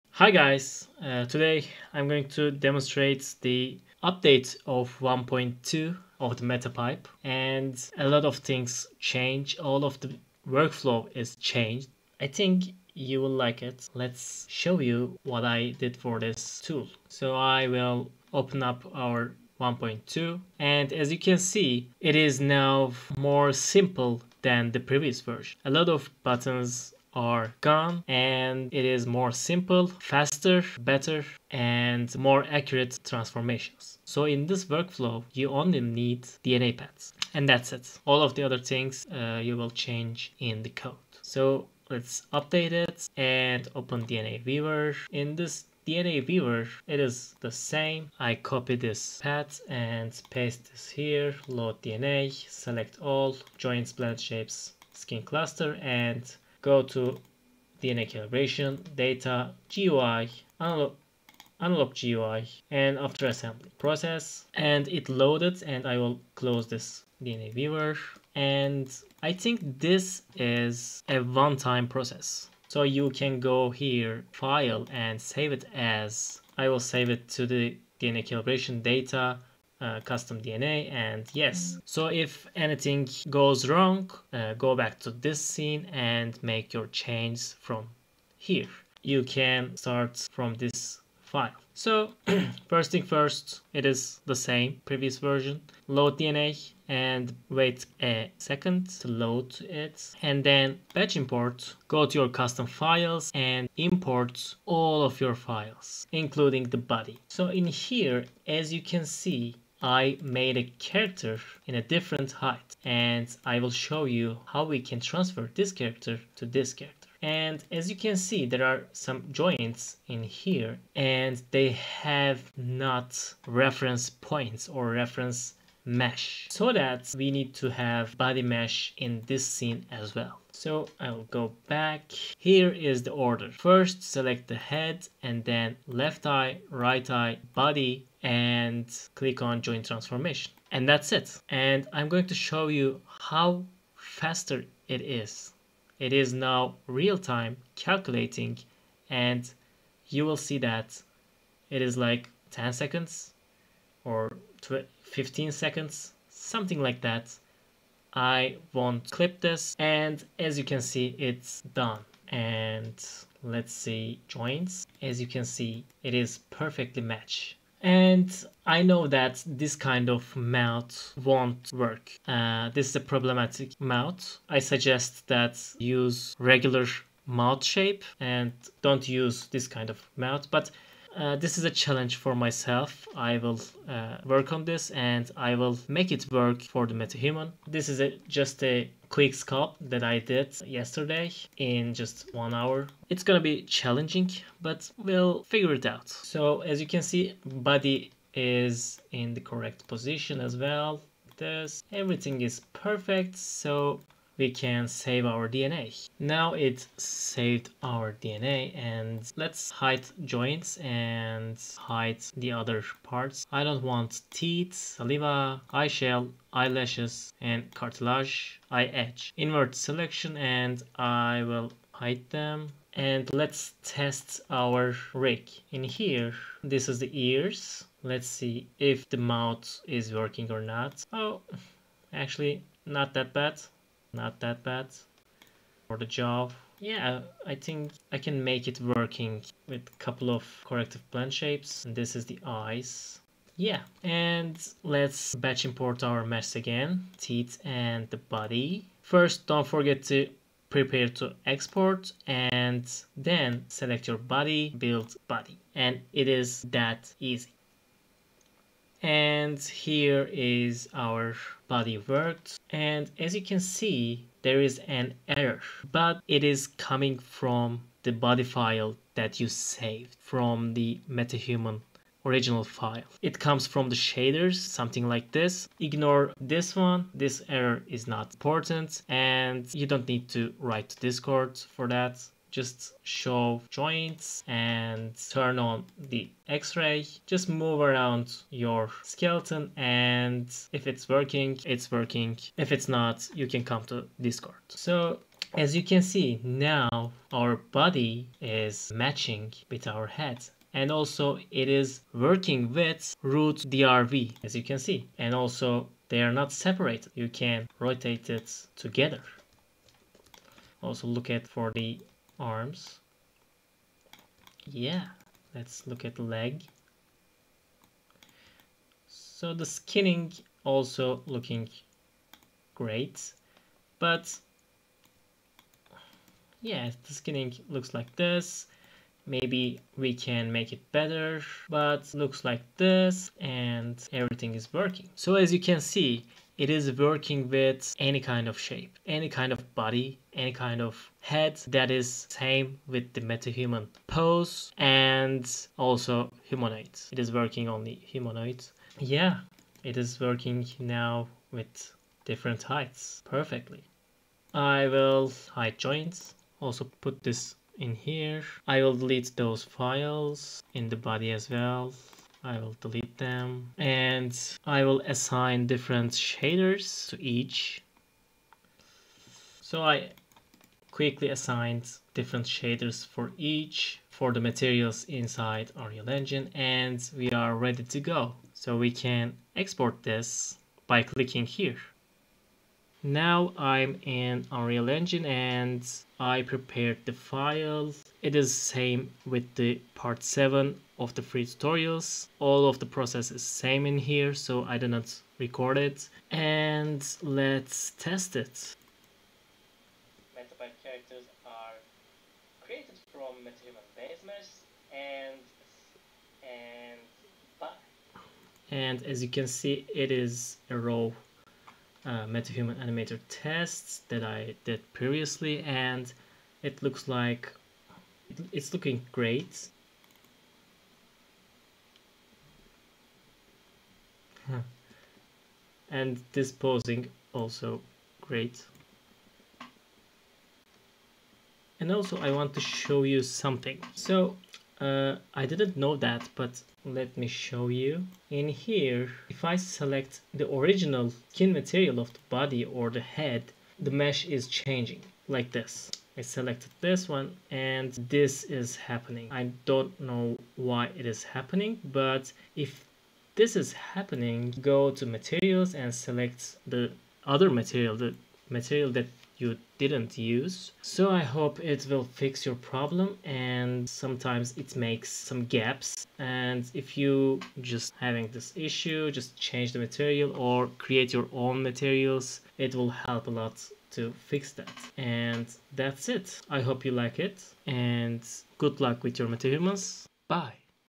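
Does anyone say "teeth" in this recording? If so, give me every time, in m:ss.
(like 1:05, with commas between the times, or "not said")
3:34, 4:07.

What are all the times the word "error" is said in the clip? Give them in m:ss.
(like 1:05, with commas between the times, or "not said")
4:25, 4:37.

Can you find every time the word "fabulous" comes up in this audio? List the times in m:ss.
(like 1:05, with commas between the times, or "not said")
not said.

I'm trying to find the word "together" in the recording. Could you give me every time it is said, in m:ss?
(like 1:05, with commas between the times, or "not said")
5:08.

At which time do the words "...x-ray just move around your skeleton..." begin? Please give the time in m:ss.
4:46.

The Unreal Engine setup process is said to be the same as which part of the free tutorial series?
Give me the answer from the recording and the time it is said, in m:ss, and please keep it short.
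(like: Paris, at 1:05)
part 7, at 6:29.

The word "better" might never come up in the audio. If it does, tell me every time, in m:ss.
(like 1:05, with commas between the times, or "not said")
0:30, 5:30.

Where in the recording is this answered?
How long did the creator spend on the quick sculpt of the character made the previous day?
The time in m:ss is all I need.
3:12.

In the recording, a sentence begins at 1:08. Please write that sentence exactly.
And I think this is a one-time process.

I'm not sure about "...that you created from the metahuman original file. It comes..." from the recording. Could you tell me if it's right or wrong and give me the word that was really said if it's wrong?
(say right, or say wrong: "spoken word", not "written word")
wrong: "saved", not "created".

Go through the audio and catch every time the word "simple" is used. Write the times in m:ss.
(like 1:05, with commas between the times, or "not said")
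0:23, 0:29.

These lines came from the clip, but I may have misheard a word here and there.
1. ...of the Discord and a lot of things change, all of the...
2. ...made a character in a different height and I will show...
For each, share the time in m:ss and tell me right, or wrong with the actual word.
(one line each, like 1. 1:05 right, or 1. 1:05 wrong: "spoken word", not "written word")
1. 0:06 wrong: "MetaPipe", not "Discord"
2. 1:50 right.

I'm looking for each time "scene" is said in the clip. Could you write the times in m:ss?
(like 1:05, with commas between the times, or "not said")
1:25, 2:09.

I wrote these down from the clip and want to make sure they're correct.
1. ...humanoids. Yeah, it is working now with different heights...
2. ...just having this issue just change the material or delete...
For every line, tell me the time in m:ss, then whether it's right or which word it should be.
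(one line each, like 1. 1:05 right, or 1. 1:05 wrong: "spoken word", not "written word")
1. 5:47 right
2. 7:47 wrong: "create", not "delete".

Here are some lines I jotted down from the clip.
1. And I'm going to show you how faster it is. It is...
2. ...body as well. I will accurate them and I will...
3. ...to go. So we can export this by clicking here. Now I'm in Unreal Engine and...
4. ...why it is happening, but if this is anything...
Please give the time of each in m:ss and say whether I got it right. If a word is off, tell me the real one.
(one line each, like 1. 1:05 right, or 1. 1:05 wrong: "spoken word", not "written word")
1. 2:21 right
2. 6:00 wrong: "delete", not "accurate"
3. 6:17 right
4. 7:30 wrong: "happening", not "anything".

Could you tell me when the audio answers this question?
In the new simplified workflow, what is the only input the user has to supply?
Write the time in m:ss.
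0:36.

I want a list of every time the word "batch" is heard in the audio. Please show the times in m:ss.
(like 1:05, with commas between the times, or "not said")
1:40, 4:05.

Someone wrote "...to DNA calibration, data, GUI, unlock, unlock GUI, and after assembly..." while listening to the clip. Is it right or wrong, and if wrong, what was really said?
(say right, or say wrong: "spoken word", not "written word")
right.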